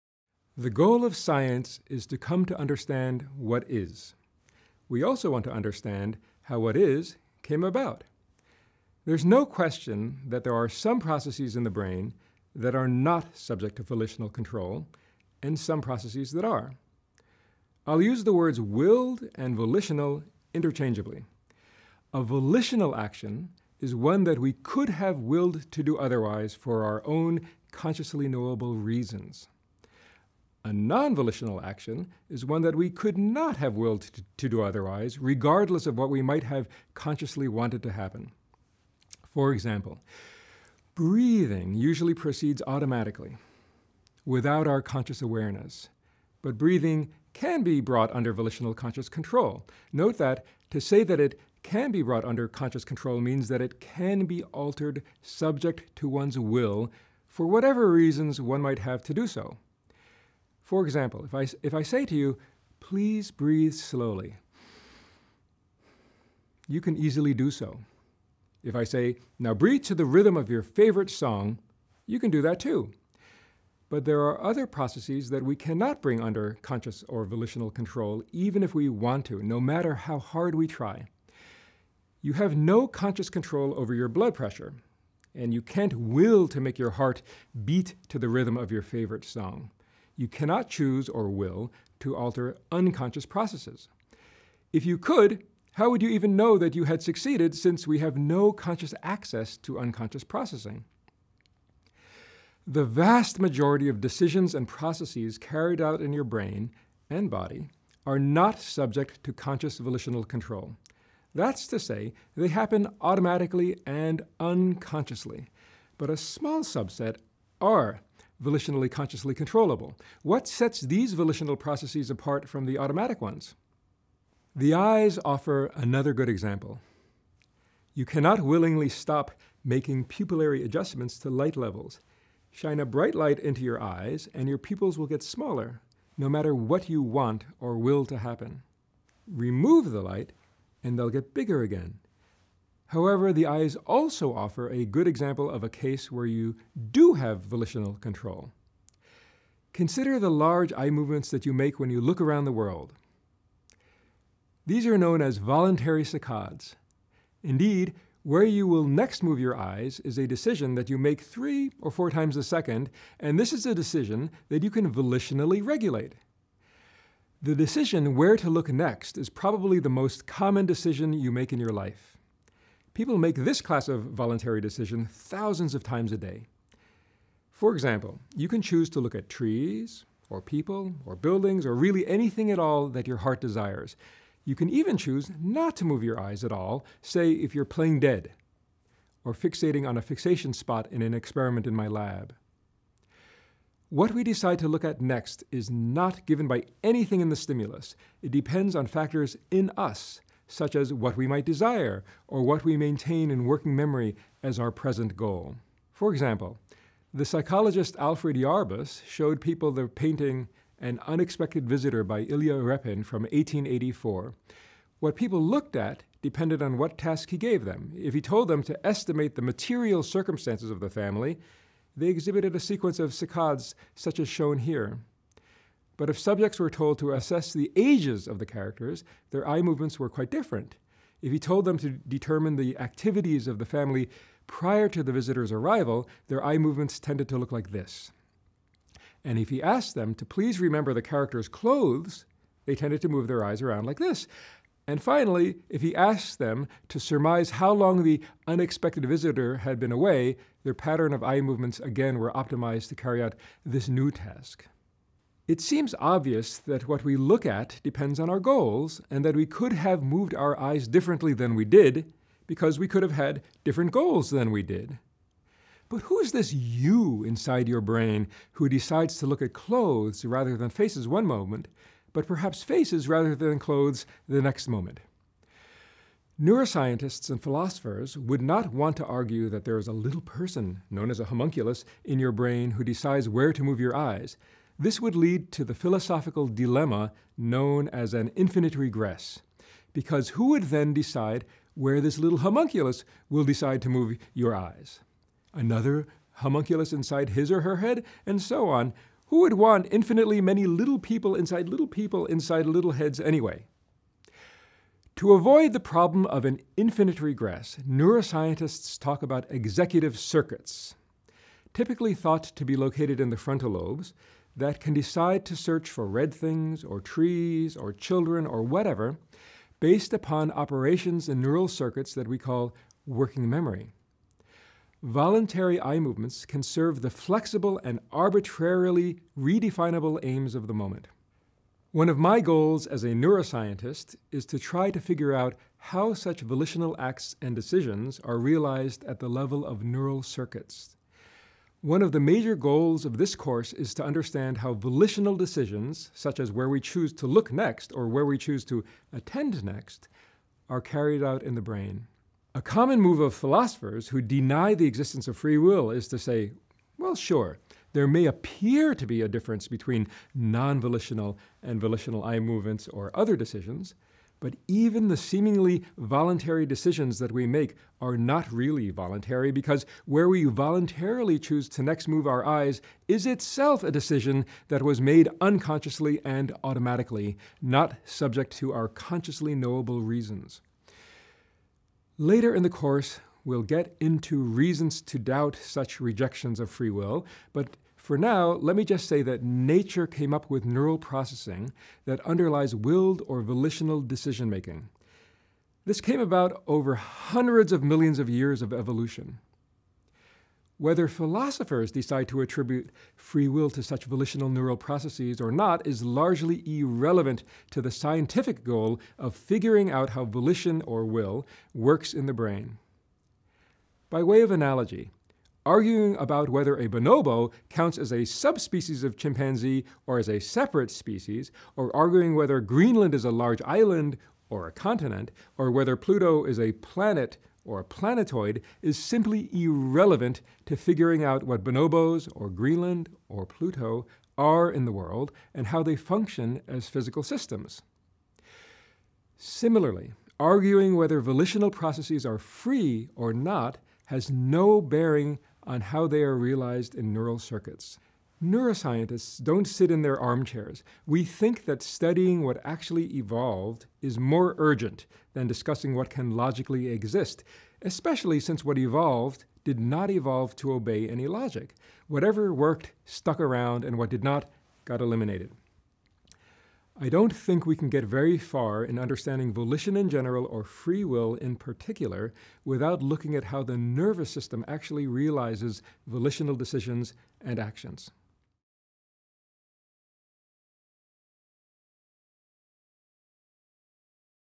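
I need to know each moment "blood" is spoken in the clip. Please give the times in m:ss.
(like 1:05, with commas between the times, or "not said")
1:24.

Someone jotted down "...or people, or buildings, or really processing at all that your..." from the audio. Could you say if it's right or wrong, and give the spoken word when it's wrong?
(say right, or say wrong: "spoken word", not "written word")
wrong: "anything", not "processing".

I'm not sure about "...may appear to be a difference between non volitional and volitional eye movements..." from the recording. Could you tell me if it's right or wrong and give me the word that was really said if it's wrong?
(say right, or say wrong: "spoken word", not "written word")
right.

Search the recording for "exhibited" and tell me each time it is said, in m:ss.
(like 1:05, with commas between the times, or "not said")
3:42.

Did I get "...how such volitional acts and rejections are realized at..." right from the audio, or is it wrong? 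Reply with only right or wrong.
wrong.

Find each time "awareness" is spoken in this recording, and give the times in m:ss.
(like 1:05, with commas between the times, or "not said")
0:45.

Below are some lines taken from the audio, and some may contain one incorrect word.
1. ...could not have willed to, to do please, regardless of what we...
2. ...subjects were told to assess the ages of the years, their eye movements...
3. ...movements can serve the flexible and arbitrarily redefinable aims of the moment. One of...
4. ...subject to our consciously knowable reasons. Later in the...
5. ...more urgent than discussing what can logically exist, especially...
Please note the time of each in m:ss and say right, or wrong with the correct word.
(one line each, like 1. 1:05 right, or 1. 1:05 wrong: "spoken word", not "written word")
1. 0:32 wrong: "otherwise", not "please"
2. 3:46 wrong: "characters", not "years"
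3. 5:25 right
4. 6:18 right
5. 7:34 right.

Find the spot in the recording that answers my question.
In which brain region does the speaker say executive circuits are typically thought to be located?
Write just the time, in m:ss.
5:13.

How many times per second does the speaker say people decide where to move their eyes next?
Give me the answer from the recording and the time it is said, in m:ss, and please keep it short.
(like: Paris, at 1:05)
3 or 4, at 2:41.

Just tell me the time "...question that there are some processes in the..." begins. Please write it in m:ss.
0:09.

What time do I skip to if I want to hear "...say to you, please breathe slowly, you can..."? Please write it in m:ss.
1:01.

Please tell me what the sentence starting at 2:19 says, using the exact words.
Remove the light, and they'll get bigger again.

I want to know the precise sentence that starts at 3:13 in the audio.
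What we decide to look at next is not given by anything in the stimulus.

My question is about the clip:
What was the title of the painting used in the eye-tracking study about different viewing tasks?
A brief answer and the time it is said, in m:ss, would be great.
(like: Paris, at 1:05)
An Unexpected Visitor, at 3:30.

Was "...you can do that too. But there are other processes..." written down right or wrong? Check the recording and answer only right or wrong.
right.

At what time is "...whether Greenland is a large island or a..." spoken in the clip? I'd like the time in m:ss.
7:02.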